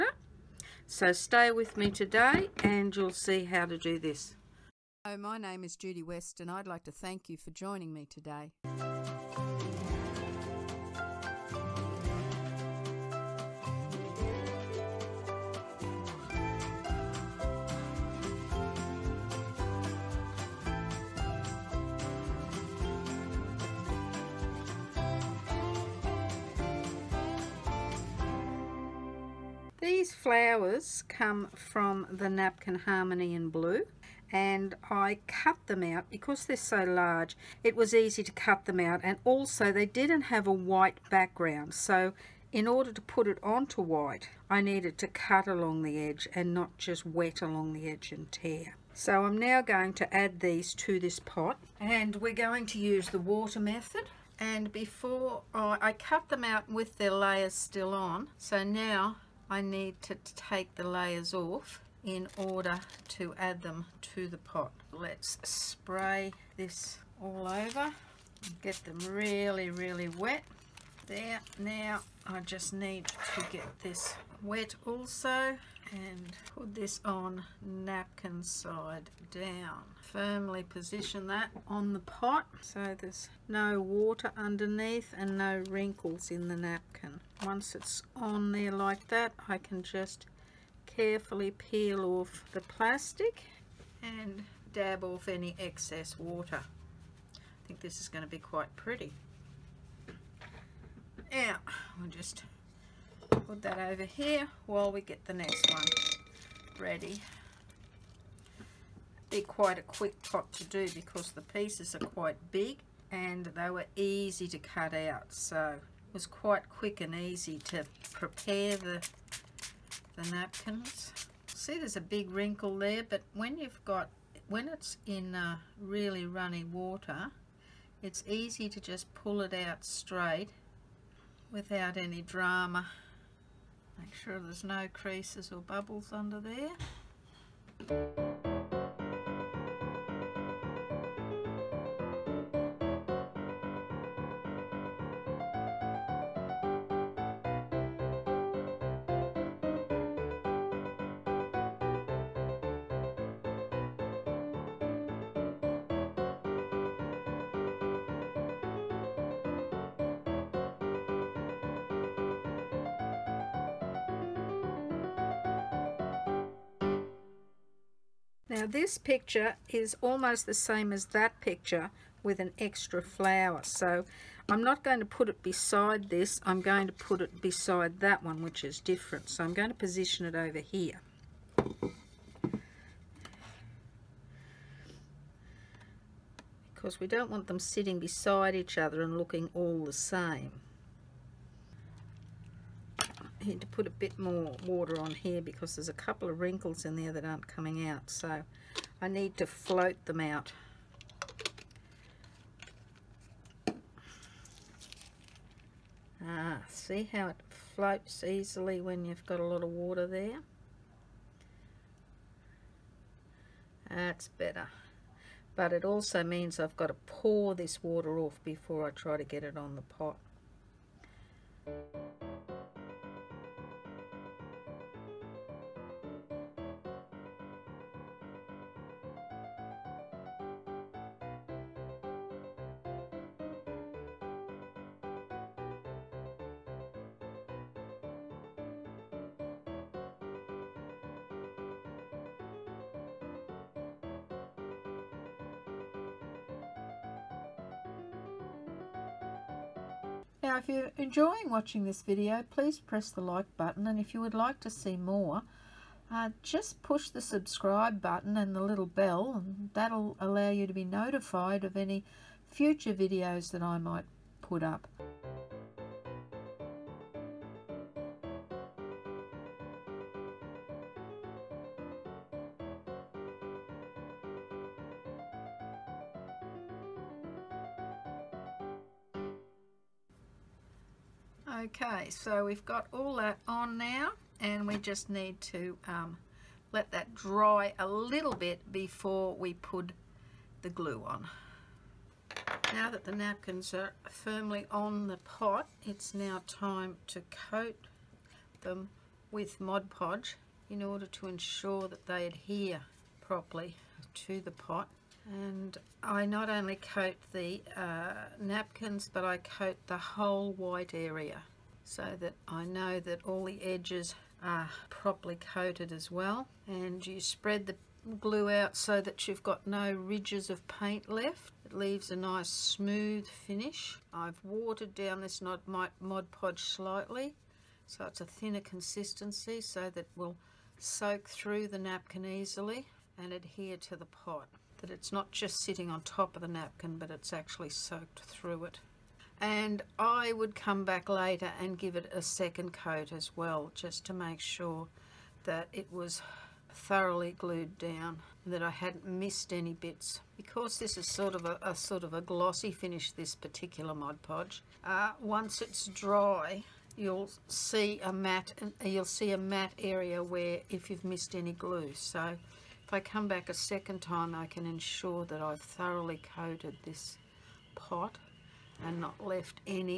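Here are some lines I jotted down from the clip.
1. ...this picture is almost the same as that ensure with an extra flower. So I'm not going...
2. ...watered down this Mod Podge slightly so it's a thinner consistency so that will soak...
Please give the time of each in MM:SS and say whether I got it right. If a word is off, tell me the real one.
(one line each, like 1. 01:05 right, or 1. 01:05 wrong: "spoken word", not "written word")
1. 02:48 wrong: "picture", not "ensure"
2. 05:24 right.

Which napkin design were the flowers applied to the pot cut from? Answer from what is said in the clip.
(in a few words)
Napkin Harmony.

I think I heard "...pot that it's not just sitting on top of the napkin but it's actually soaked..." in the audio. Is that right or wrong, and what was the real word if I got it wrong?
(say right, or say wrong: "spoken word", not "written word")
right.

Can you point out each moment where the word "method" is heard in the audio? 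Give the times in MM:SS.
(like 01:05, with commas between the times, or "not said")
00:53.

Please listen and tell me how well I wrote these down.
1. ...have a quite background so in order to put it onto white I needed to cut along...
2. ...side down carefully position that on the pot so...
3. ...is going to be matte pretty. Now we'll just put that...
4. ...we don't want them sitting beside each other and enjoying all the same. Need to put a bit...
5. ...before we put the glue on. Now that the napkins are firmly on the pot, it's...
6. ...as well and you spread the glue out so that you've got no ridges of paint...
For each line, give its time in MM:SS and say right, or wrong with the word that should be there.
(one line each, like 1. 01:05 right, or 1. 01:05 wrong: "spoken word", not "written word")
1. 00:40 wrong: "white", not "quite"
2. 01:18 wrong: "firmly", not "carefully"
3. 01:37 wrong: "quite", not "matte"
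4. 03:07 wrong: "looking", not "enjoying"
5. 04:48 right
6. 05:15 right.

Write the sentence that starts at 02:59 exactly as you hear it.
So I'm going to position it over here.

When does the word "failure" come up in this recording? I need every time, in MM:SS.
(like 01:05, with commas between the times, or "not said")
not said.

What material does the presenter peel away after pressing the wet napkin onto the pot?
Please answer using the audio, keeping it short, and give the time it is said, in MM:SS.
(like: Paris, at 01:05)
Plastic, at 01:32.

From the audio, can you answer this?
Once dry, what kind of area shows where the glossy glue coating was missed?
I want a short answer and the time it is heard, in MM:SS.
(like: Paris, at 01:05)
A matte area, at 05:59.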